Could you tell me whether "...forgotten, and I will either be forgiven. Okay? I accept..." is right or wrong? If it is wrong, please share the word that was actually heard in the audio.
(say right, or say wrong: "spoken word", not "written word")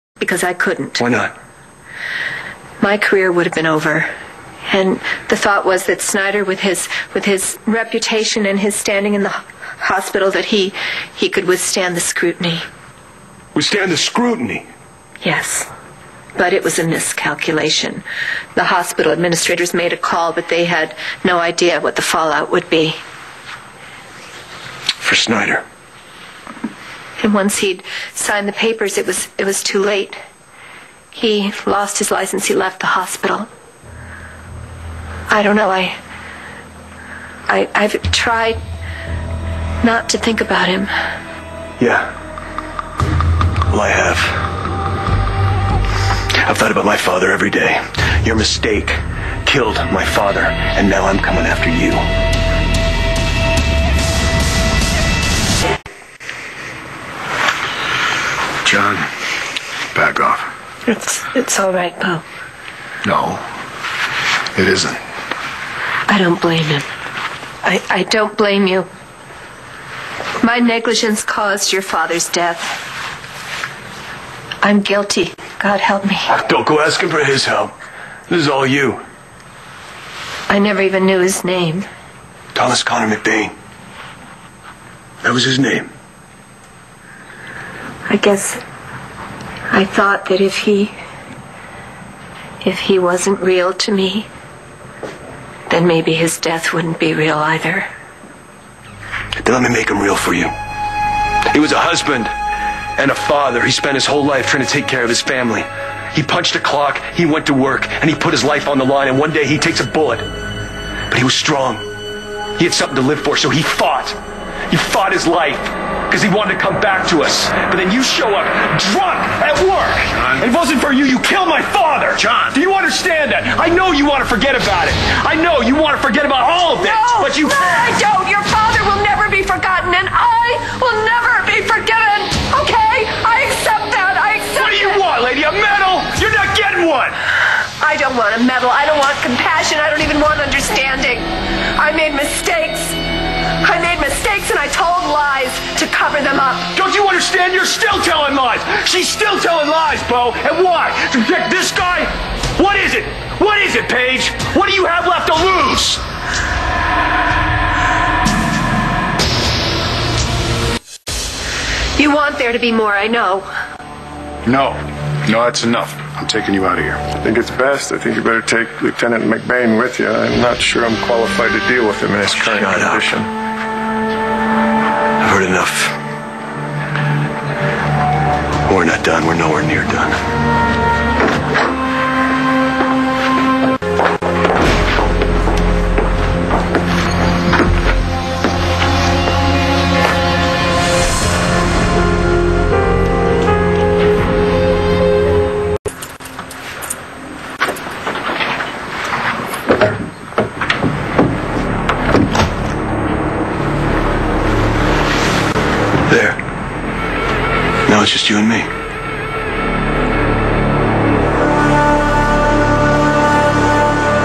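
wrong: "never", not "either".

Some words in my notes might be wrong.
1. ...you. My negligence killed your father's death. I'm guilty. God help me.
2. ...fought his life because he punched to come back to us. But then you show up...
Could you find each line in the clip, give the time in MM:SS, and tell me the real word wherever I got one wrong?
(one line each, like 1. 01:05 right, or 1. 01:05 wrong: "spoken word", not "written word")
1. 01:08 wrong: "caused", not "killed"
2. 01:54 wrong: "wanted", not "punched".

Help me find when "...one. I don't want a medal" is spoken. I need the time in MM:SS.
02:16.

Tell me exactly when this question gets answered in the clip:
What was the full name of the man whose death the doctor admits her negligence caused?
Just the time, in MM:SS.
01:22.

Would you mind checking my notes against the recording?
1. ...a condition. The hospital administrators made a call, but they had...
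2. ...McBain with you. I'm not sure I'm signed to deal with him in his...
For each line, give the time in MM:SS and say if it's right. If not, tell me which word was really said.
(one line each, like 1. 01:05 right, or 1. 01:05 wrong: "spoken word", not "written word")
1. 00:16 wrong: "miscalculation", not "condition"
2. 02:49 wrong: "qualified", not "signed".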